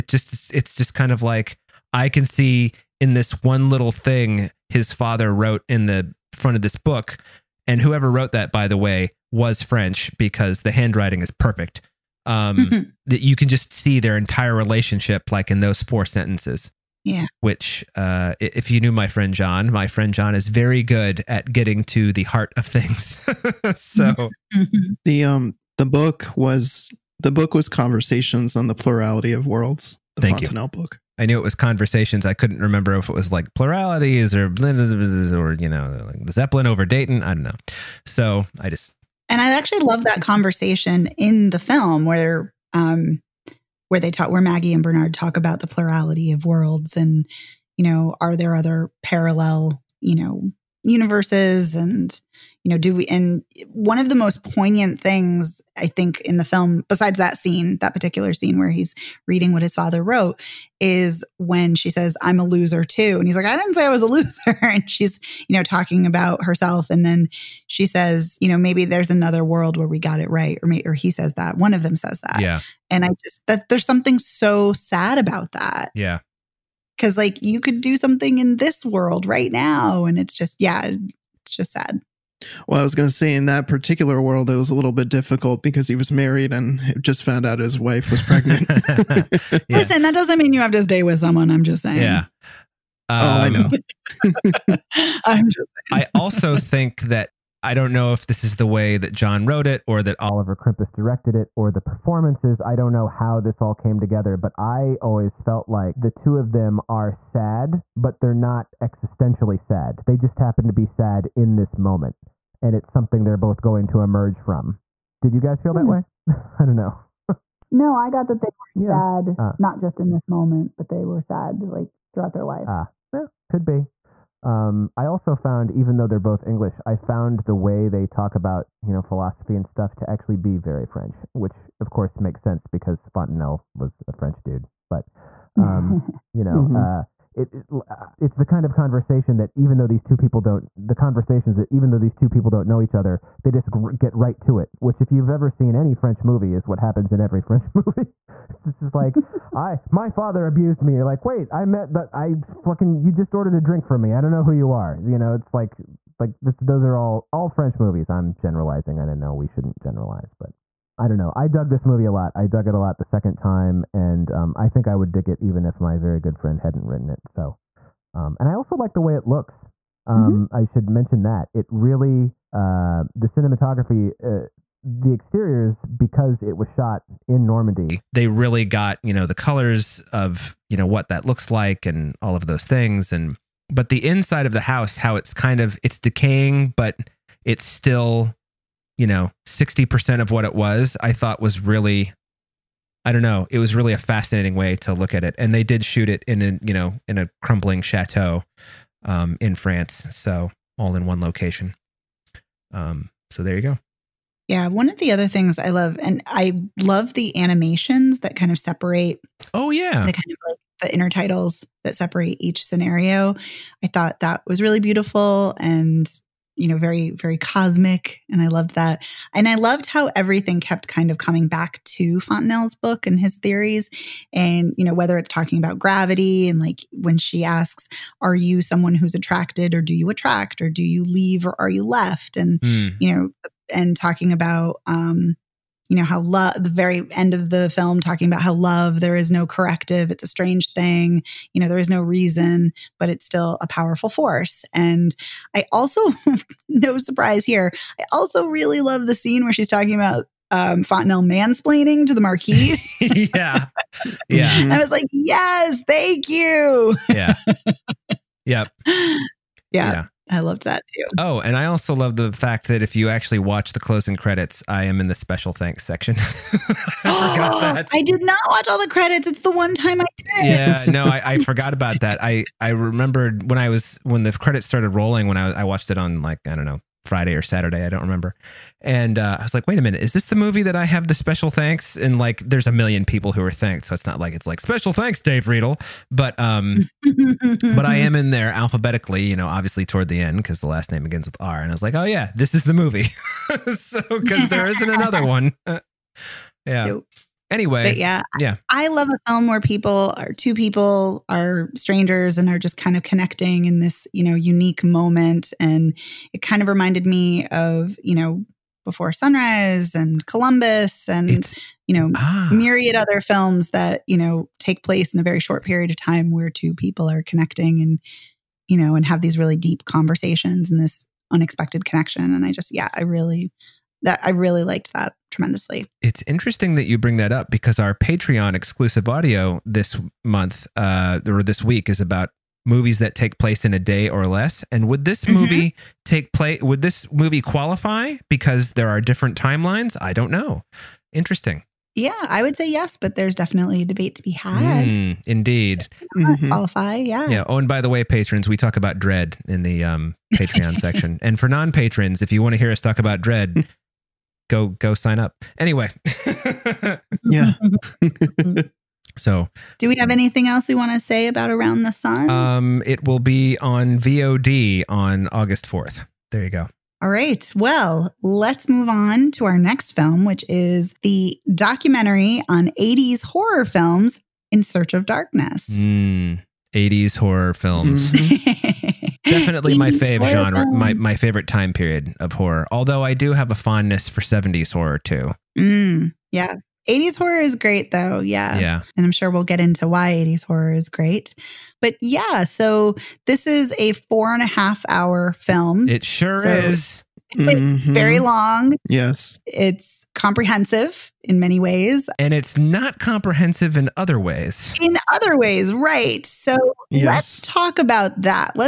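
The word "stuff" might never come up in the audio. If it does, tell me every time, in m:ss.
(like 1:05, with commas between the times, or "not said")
2:09.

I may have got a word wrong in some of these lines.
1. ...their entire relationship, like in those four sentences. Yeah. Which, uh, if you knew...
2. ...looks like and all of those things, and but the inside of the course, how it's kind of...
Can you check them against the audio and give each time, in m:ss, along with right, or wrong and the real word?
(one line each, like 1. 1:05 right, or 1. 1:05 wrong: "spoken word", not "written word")
1. 0:13 right
2. 3:01 wrong: "house", not "course".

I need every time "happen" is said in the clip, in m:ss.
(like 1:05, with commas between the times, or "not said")
1:50, 2:26.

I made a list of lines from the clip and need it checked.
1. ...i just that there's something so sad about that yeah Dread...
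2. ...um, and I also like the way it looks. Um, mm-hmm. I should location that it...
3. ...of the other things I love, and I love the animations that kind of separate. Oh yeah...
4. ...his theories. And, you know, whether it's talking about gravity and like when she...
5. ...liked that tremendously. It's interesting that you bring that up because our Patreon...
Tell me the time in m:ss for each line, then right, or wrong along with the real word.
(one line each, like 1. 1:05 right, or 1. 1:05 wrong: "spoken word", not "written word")
1. 1:13 wrong: "Cause", not "Dread"
2. 2:48 wrong: "mention", not "location"
3. 3:24 right
4. 3:43 right
5. 5:24 right.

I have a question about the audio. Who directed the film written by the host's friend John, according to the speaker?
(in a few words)
Oliver Krimpas.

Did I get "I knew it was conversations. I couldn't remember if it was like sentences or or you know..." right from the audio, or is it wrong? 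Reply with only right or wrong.
wrong.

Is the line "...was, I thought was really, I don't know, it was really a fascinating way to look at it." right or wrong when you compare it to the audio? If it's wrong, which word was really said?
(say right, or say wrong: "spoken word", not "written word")
right.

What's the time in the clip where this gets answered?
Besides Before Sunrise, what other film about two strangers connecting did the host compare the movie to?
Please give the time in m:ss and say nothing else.
5:10.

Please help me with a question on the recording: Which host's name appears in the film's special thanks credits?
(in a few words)
Dave Riedel.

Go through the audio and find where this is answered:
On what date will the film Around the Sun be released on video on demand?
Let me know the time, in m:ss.
6:05.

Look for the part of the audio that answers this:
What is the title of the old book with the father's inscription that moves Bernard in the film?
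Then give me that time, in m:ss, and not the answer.
0:27.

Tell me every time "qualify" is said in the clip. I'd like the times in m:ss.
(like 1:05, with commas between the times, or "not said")
5:37, 5:46.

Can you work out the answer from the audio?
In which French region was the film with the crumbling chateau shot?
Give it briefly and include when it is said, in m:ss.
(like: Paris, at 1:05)
Normandy, at 2:57.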